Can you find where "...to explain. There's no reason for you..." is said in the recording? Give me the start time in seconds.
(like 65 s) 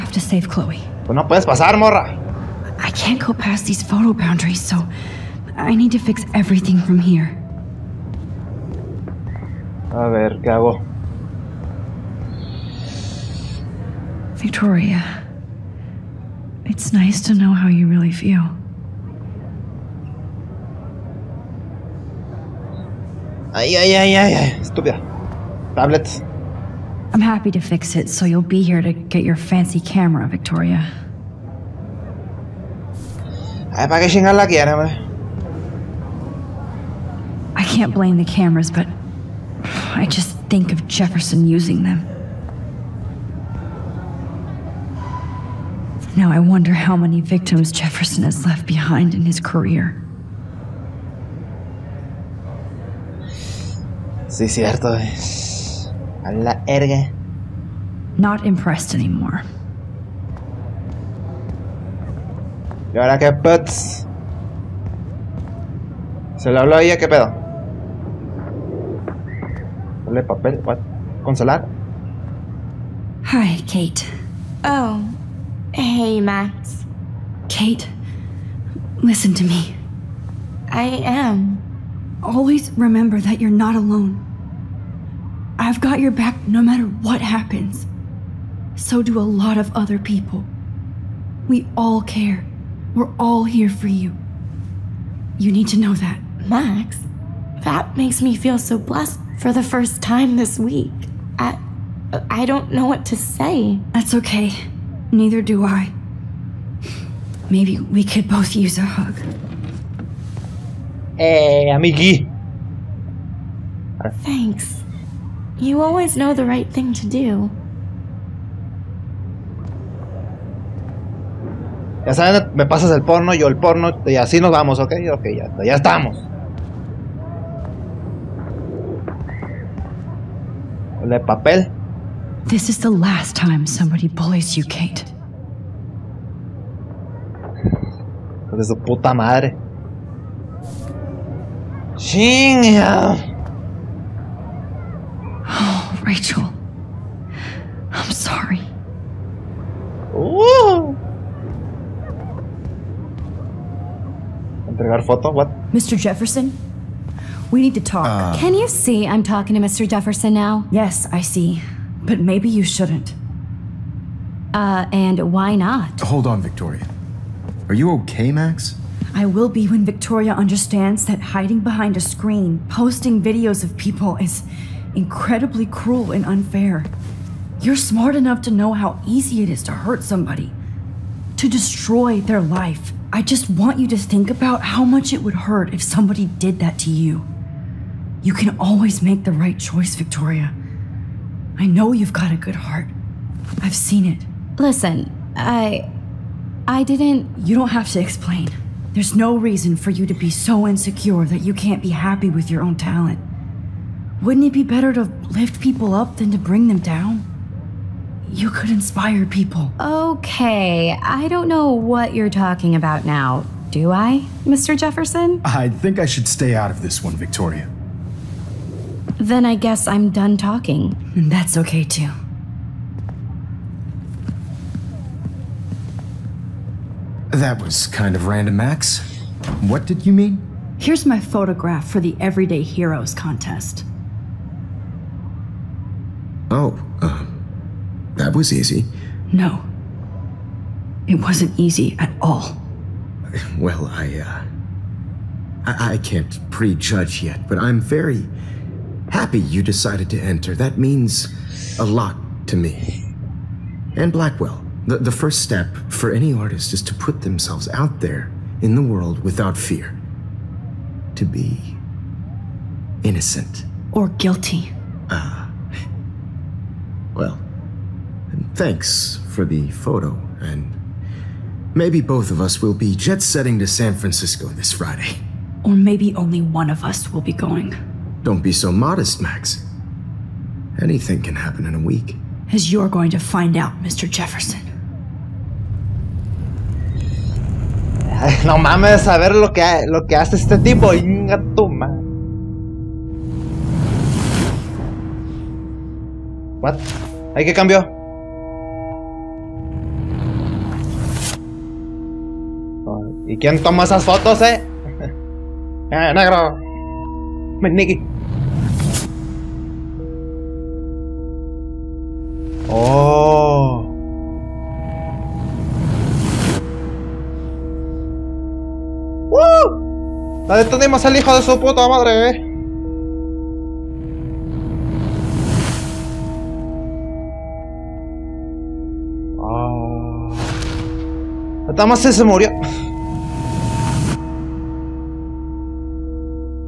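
197 s.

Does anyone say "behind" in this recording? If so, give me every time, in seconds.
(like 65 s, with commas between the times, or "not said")
48 s, 171 s.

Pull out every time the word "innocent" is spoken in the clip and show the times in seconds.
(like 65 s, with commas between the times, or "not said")
263 s.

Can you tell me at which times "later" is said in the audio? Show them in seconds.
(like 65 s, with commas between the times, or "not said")
not said.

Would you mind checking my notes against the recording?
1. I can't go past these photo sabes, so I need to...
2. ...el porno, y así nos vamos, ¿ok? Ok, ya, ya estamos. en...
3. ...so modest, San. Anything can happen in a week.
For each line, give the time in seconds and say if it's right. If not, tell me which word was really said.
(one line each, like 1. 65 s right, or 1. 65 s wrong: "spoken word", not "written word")
1. 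2 s wrong: "boundaries", not "sabes"
2. 123 s right
3. 278 s wrong: "Max", not "San".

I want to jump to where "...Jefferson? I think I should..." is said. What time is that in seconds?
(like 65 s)
214 s.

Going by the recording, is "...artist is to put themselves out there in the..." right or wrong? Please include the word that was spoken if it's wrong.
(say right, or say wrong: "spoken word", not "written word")
right.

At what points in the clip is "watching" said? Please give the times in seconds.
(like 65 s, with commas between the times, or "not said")
not said.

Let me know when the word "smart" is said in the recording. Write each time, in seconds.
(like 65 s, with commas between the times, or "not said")
177 s.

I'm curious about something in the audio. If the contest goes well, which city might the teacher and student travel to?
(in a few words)
San Francisco.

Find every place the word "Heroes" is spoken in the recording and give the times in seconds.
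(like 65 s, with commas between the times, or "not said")
232 s.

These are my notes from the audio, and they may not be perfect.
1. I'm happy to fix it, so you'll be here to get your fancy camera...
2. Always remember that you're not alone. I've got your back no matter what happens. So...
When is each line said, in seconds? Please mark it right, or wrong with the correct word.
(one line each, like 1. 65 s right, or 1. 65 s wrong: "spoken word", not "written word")
1. 27 s right
2. 82 s right.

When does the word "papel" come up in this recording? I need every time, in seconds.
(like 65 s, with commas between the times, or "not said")
70 s, 131 s.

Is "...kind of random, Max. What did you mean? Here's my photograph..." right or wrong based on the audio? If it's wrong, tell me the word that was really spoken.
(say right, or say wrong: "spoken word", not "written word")
right.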